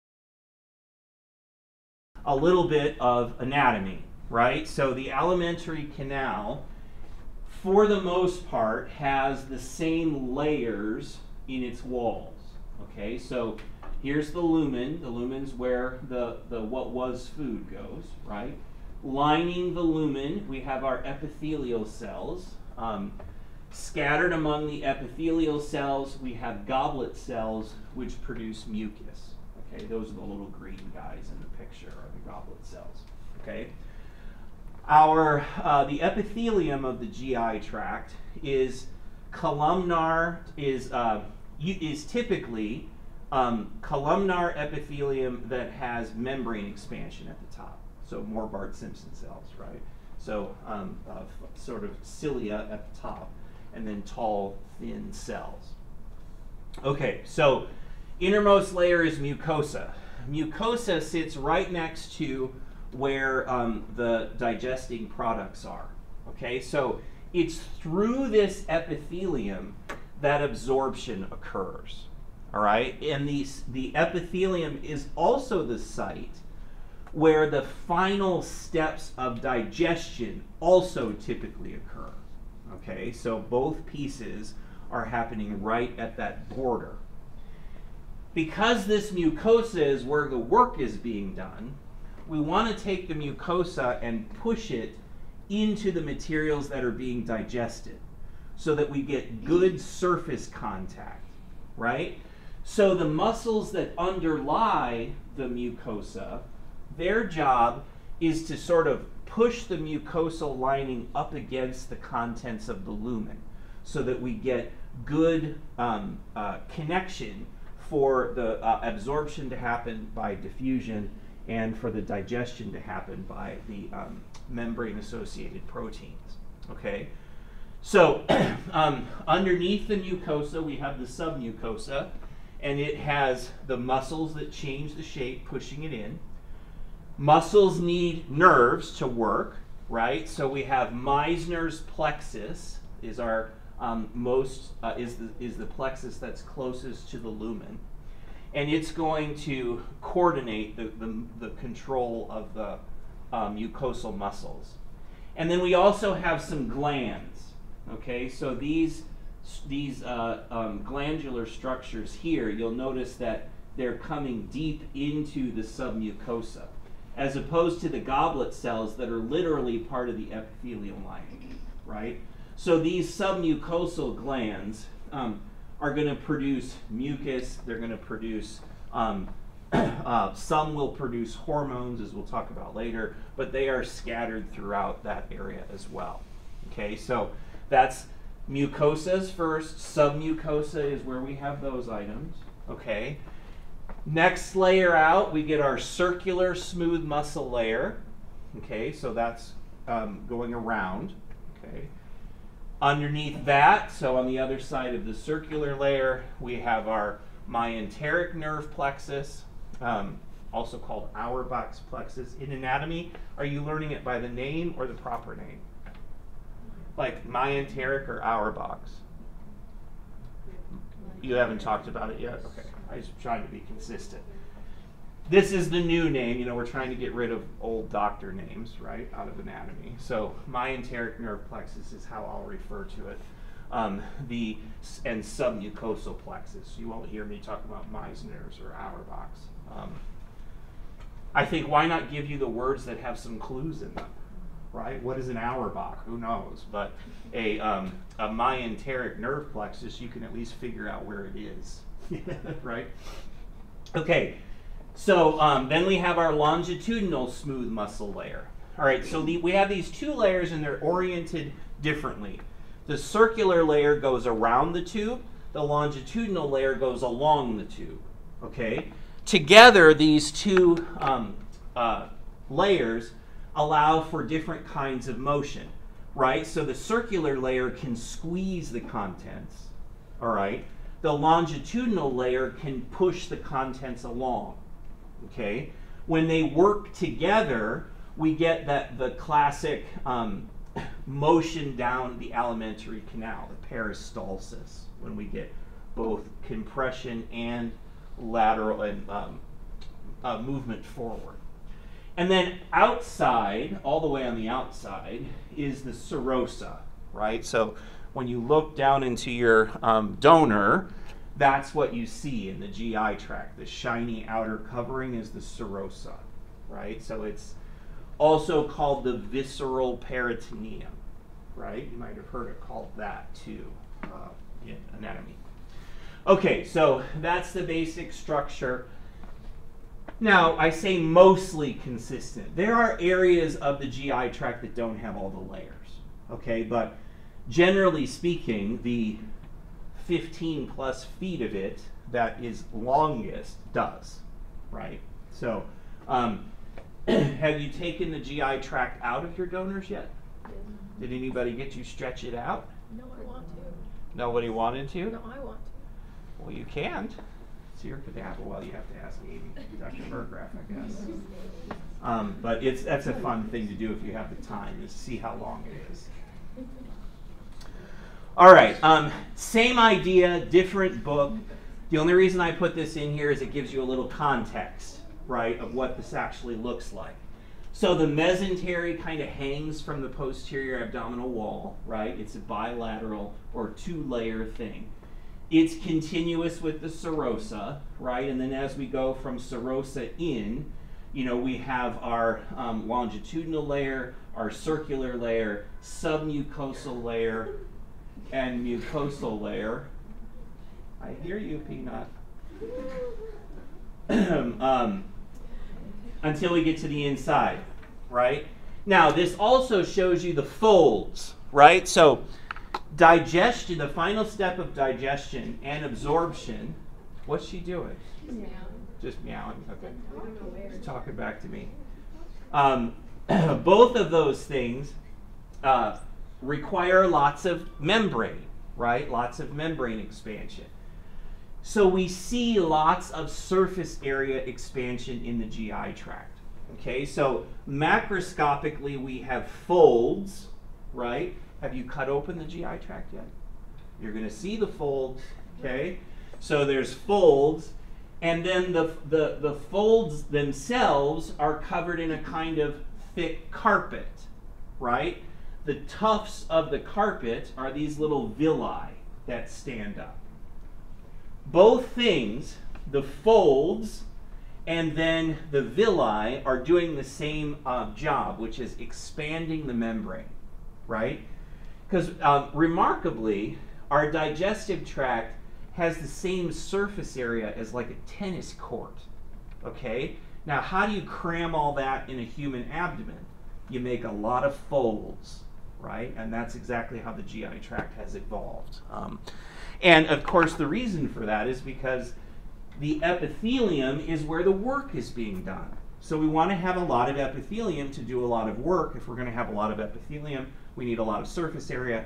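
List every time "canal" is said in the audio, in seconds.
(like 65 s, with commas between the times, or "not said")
5 s, 293 s.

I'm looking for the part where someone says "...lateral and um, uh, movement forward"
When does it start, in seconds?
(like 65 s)
298 s.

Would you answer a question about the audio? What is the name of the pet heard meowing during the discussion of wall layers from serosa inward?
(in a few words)
Peanut.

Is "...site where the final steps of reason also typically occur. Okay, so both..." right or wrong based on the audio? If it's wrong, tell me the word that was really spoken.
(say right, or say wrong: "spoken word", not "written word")
wrong: "digestion", not "reason".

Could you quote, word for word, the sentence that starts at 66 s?
Okay, so it's through this epithelium that absorption occurs.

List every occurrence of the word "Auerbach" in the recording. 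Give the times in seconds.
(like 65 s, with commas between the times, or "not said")
211 s, 218 s, 238 s, 245 s.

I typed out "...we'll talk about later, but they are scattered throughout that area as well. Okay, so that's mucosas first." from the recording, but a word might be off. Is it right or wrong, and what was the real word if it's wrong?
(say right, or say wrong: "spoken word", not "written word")
right.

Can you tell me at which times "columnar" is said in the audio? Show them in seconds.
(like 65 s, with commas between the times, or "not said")
39 s, 43 s.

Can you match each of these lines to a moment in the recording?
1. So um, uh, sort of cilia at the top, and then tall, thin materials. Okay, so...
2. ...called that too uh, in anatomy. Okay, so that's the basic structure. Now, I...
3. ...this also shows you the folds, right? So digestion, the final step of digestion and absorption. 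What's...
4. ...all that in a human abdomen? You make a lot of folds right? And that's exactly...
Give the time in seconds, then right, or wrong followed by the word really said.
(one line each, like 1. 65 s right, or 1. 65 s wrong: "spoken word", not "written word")
1. 50 s wrong: "cells", not "materials"
2. 322 s right
3. 409 s right
4. 481 s right.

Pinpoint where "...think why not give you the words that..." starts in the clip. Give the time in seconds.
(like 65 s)
241 s.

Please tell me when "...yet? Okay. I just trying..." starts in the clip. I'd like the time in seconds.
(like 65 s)
222 s.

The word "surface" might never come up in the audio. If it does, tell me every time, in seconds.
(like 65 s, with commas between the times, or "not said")
99 s, 433 s, 476 s, 501 s.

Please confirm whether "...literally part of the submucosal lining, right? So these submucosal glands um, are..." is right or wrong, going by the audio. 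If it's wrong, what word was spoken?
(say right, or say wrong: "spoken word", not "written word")
wrong: "epithelial", not "submucosal".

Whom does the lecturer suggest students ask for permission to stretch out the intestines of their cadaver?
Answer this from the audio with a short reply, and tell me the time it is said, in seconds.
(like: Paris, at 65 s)
Dr. Burgraff, at 359 s.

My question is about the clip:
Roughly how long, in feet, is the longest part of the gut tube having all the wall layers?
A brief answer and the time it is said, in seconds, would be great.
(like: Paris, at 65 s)
15 plus feet, at 340 s.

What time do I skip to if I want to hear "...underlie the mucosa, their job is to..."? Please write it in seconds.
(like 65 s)
103 s.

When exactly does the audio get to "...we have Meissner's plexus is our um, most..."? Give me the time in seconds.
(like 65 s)
140 s.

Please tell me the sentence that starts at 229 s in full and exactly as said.
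So myenteric nerve plexus is how I'll refer to it.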